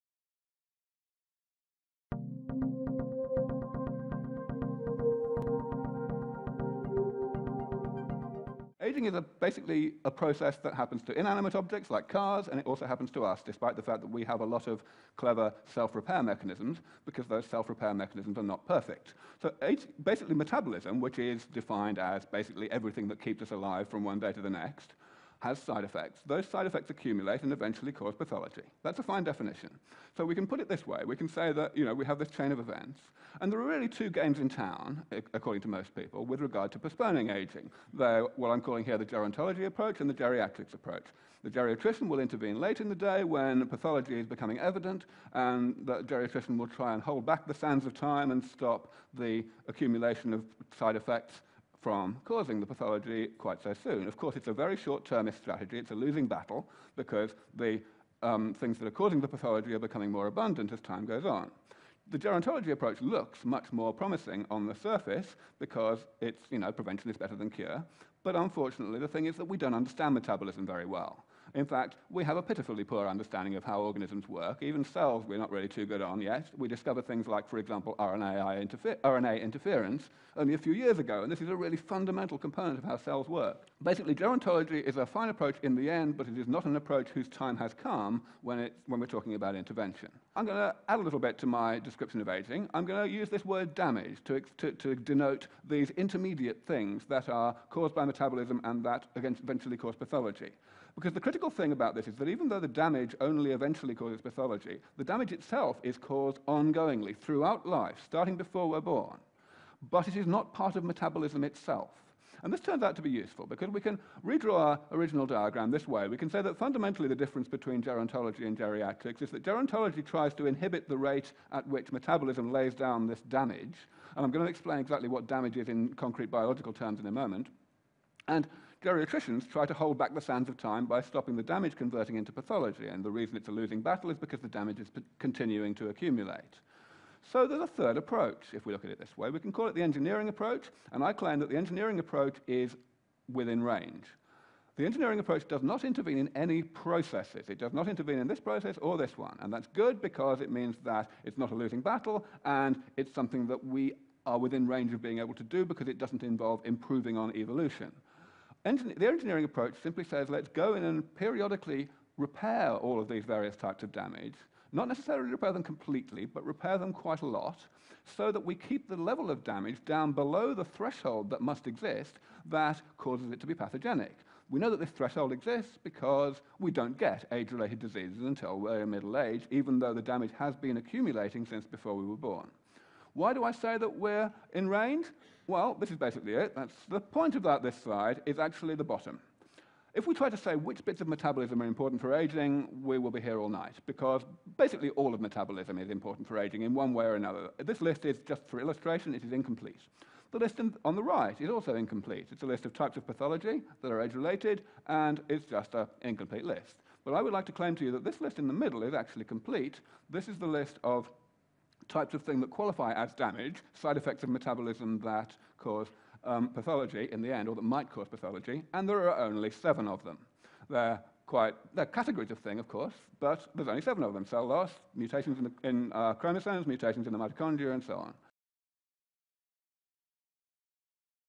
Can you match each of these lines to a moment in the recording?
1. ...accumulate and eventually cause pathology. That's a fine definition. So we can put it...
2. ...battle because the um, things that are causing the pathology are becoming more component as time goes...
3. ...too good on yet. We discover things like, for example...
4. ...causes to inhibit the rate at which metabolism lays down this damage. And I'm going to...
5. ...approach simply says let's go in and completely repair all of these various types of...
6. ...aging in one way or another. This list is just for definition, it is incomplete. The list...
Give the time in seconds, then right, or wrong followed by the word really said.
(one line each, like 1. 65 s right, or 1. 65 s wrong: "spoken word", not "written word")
1. 26 s right
2. 56 s wrong: "abundant", not "component"
3. 75 s right
4. 120 s wrong: "tries", not "causes"
5. 159 s wrong: "periodically", not "completely"
6. 196 s wrong: "illustration", not "definition".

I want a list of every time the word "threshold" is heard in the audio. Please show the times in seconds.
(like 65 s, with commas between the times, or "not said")
170 s, 174 s.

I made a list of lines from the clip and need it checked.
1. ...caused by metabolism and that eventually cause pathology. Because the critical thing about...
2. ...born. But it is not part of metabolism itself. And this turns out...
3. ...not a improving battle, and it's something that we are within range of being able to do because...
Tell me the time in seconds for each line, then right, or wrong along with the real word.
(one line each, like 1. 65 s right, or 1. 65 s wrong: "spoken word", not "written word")
1. 97 s right
2. 108 s right
3. 151 s wrong: "losing", not "improving".